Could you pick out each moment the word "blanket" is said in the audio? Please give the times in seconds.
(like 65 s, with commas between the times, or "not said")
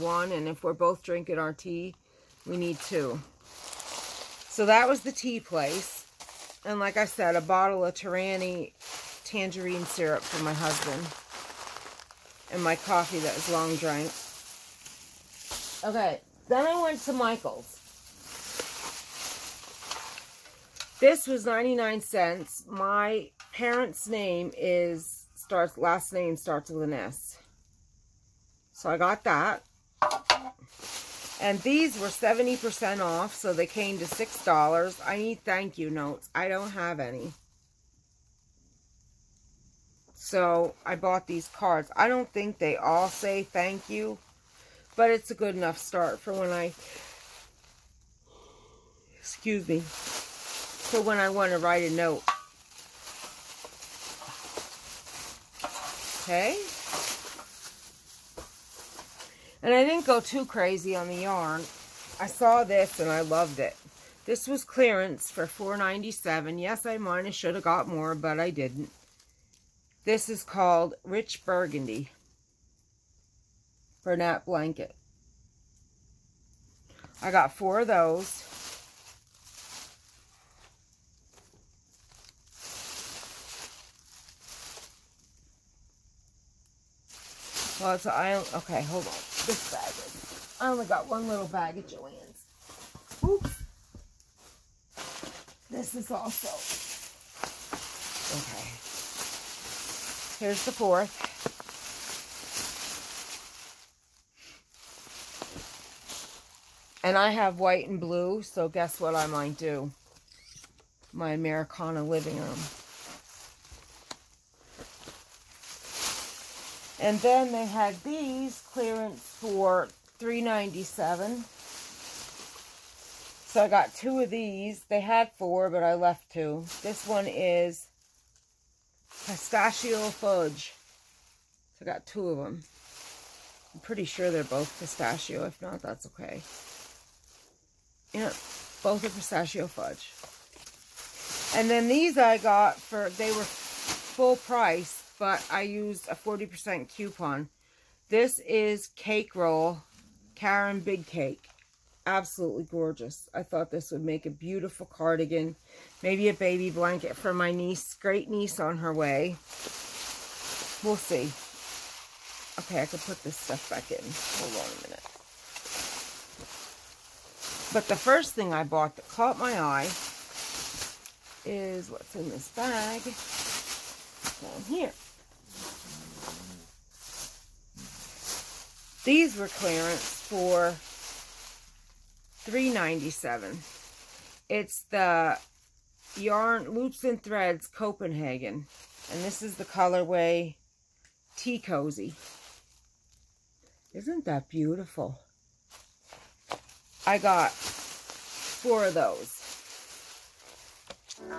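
74 s, 156 s.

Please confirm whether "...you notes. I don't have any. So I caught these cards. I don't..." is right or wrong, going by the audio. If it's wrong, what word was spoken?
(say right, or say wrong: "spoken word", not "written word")
wrong: "bought", not "caught".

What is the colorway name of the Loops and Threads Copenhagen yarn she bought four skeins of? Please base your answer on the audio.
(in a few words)
Tea Cozy.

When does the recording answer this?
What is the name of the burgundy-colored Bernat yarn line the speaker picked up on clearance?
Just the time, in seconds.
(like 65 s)
71 s.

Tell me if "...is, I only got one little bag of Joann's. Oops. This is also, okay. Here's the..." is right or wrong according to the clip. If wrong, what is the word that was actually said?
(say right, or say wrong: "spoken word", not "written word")
right.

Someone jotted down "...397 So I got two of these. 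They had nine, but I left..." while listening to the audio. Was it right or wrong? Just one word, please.
wrong.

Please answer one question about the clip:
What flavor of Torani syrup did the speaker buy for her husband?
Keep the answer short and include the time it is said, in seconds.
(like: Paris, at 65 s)
Tangerine, at 9 s.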